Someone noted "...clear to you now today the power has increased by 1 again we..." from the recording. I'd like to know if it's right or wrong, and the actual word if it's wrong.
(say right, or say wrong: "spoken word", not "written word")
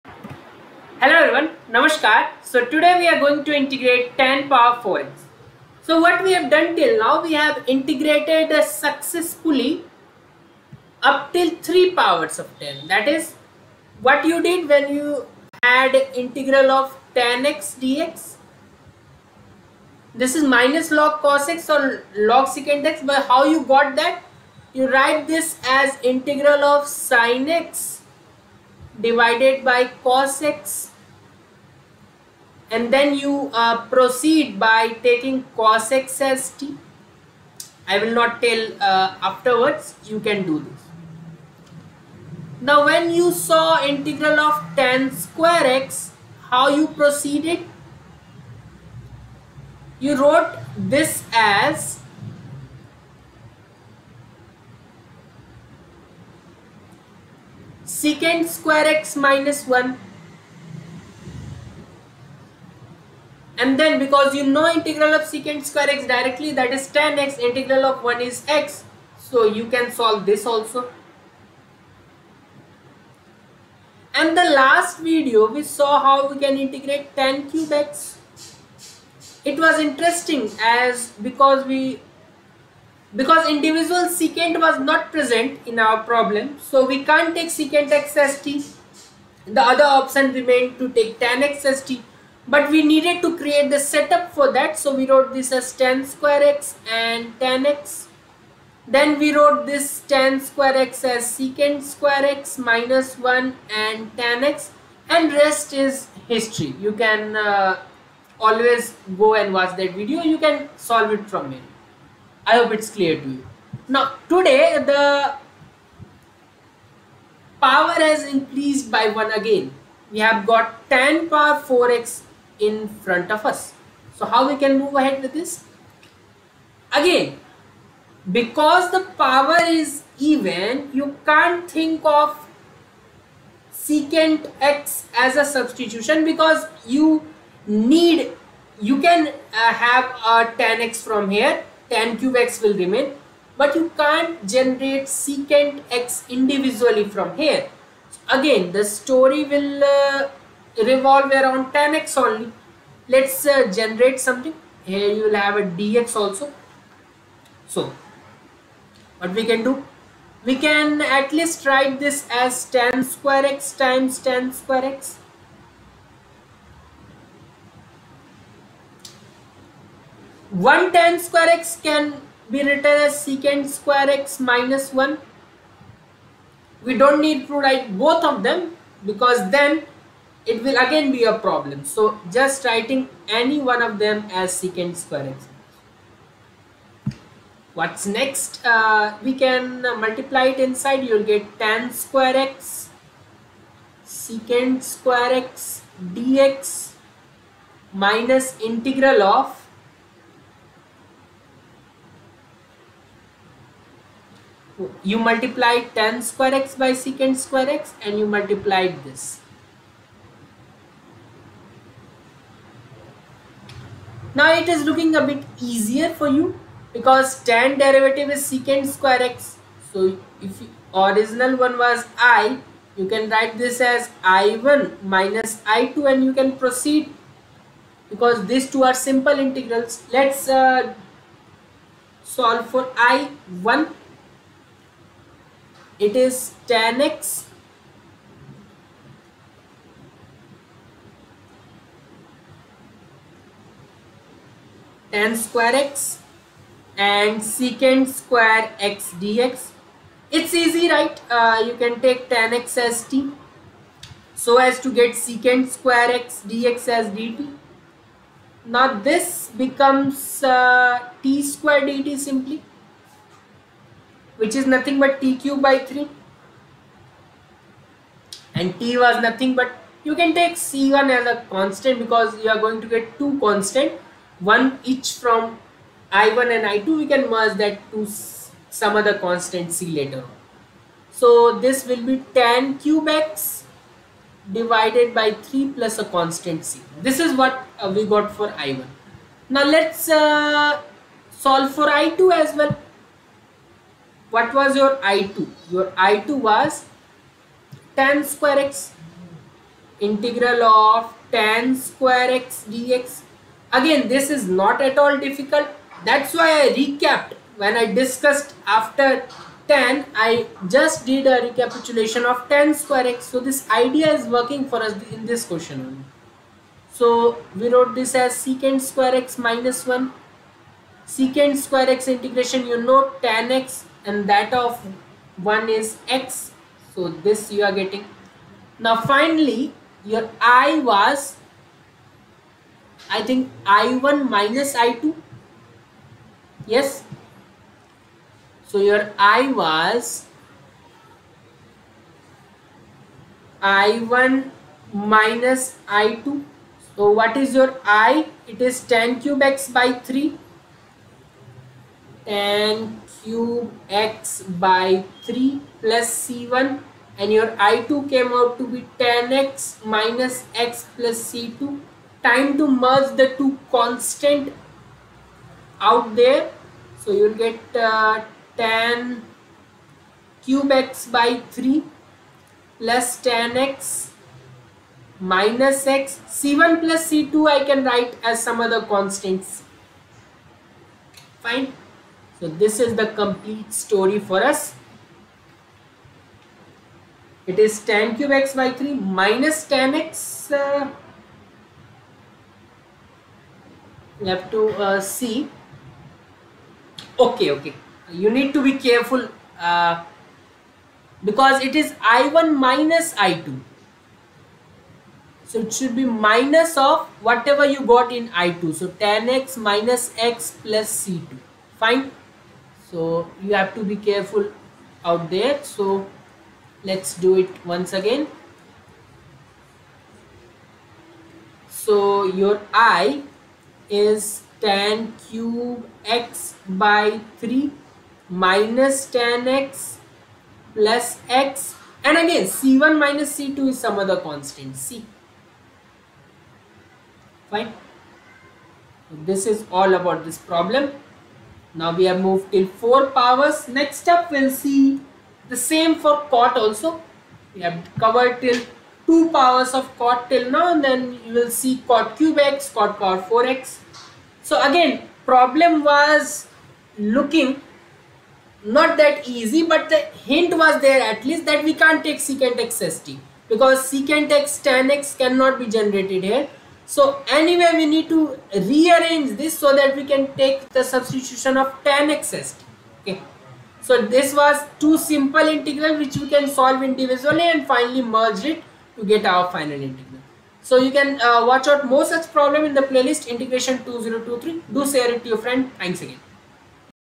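right.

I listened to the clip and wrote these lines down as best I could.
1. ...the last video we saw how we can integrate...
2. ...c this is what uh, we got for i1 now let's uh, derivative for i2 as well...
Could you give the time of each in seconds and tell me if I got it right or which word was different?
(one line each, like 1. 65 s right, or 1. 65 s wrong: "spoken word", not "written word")
1. 74 s right
2. 286 s wrong: "solve", not "derivative".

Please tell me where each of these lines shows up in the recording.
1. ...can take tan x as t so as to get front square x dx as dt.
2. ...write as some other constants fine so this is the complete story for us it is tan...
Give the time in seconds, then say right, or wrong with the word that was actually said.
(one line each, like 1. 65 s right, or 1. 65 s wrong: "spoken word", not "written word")
1. 251 s wrong: "secant", not "front"
2. 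377 s right.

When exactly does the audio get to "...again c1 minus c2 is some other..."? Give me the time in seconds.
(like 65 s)
432 s.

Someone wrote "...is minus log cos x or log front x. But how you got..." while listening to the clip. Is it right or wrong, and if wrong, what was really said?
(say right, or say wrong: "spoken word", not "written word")
wrong: "secant", not "front".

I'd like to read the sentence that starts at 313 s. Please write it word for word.
So this idea is working for us in this question So we wrote this as secant square x minus 1.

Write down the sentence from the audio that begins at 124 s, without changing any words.
So how we can move ahead with this?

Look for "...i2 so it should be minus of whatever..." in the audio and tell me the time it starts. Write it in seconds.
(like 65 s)
403 s.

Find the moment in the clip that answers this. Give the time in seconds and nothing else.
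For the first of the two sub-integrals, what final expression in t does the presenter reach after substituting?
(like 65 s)
265 s.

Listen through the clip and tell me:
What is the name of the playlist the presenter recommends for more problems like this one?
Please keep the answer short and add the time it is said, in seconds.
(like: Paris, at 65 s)
integration 2023, at 483 s.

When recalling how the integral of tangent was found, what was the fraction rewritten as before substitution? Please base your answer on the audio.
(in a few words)
sine x divided by cos x.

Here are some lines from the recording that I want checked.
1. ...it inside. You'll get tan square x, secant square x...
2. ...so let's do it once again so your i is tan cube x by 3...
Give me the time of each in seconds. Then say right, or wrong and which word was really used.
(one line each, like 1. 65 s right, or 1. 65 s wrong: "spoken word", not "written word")
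1. 190 s right
2. 415 s right.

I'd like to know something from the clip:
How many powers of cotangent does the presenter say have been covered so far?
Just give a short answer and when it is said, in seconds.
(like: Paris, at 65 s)
2, at 449 s.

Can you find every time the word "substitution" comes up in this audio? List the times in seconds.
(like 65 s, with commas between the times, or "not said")
135 s, 470 s.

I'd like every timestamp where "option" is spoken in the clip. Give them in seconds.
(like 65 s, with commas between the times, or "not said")
90 s.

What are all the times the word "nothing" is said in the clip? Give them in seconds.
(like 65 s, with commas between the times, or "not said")
264 s, 269 s.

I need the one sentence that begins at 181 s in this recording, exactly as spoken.
So just writing any one of them as secant square x.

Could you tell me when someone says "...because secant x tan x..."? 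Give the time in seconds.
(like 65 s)
463 s.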